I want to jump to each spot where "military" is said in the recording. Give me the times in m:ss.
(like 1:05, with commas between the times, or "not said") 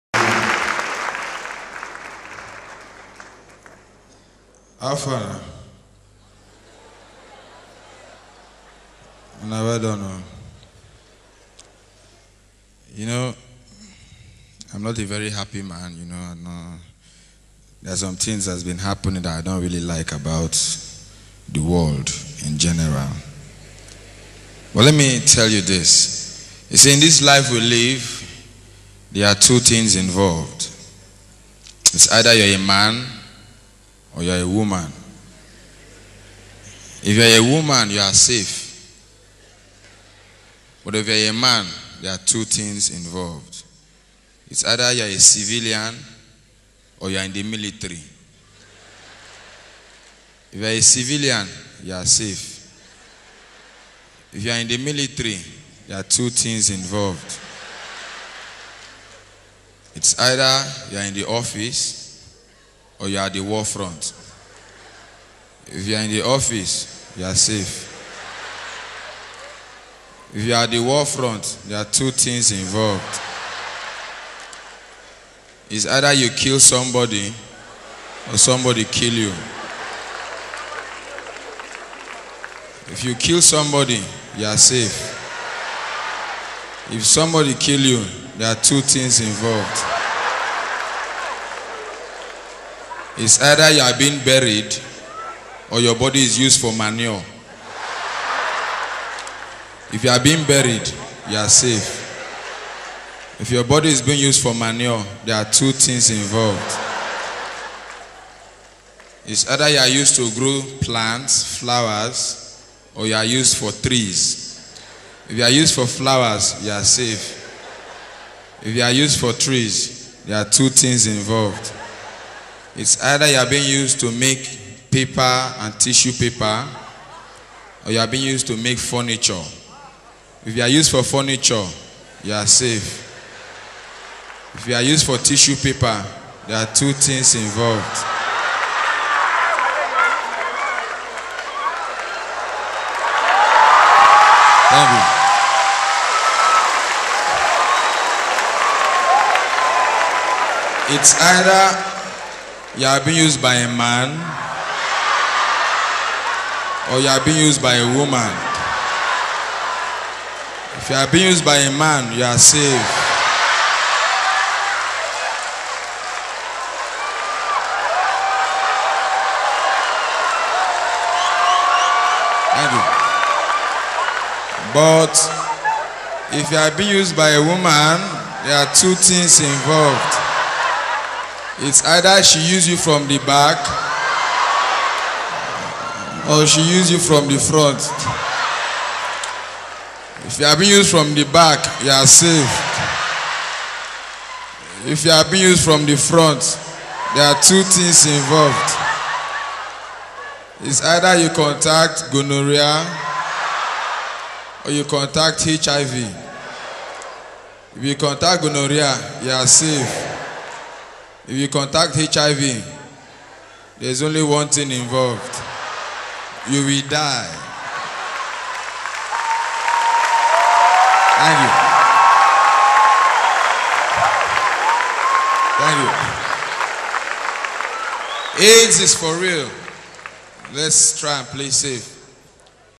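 0:47, 0:54.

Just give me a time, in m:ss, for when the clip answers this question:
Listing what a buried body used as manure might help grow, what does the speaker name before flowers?
1:50.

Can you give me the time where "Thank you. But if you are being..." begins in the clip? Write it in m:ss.
2:52.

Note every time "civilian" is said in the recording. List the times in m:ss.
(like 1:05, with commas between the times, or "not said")
0:45, 0:50.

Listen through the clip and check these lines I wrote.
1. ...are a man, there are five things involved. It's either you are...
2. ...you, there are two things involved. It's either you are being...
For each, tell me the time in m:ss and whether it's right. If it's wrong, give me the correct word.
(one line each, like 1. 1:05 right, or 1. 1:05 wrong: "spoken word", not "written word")
1. 0:41 wrong: "two", not "five"
2. 1:27 right.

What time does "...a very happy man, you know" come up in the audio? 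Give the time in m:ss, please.
0:14.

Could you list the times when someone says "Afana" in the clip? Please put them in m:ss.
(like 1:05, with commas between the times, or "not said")
0:04.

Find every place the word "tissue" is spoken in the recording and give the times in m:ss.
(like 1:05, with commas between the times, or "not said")
2:05, 2:15.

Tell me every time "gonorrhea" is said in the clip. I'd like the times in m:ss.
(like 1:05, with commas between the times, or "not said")
3:22, 3:28.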